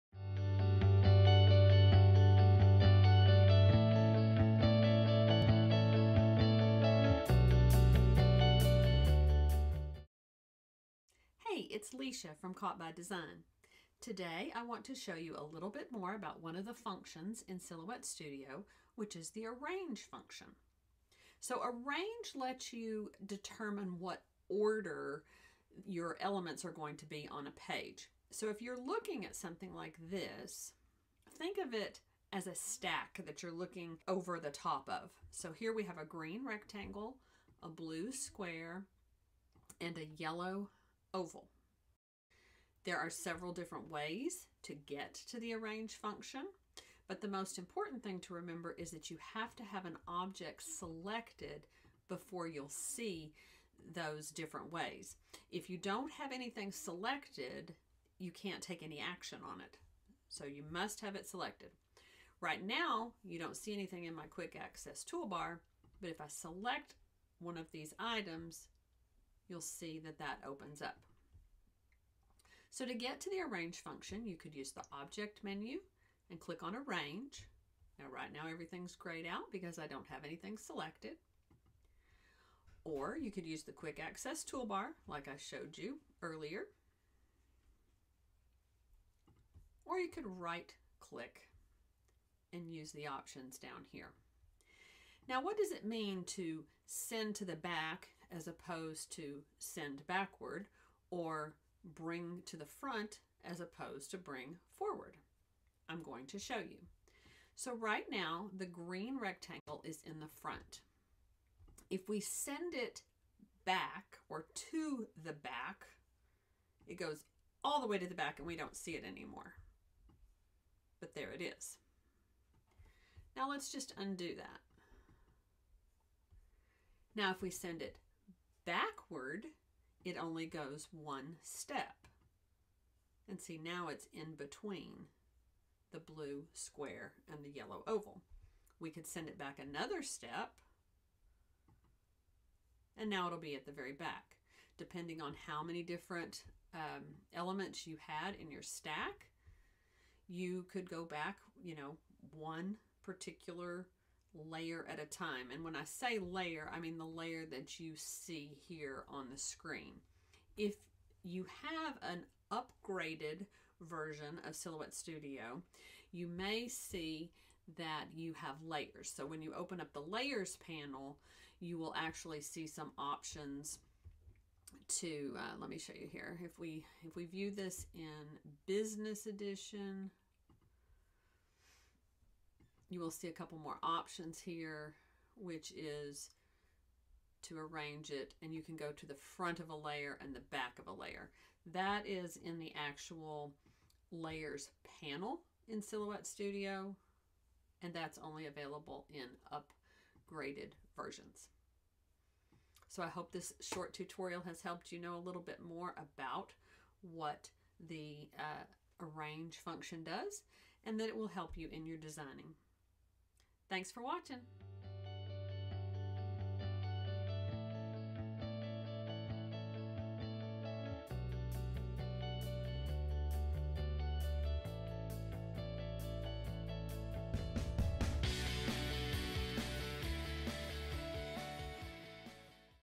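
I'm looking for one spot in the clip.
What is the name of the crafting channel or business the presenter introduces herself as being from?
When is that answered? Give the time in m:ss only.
0:12.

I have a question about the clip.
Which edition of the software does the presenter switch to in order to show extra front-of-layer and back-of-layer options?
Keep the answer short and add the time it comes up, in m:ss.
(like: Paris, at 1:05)
Business edition, at 2:58.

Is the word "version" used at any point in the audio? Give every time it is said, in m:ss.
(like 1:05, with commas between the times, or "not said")
2:43, 3:20.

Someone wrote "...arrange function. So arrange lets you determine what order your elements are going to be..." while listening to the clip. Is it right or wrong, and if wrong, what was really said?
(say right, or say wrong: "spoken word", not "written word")
right.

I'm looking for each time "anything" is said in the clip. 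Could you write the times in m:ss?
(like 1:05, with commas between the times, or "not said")
0:56, 1:03, 1:20.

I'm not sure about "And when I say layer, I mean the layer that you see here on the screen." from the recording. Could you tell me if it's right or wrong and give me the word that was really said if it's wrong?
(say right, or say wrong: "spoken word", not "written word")
right.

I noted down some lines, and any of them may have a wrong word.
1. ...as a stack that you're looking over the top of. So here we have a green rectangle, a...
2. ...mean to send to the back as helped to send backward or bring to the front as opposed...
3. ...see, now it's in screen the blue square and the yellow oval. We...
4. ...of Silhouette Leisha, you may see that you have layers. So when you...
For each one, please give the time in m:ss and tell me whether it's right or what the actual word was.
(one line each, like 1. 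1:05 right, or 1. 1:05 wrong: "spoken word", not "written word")
1. 0:32 right
2. 1:35 wrong: "opposed", not "helped"
3. 2:13 wrong: "between", not "screen"
4. 2:44 wrong: "Studio", not "Leisha".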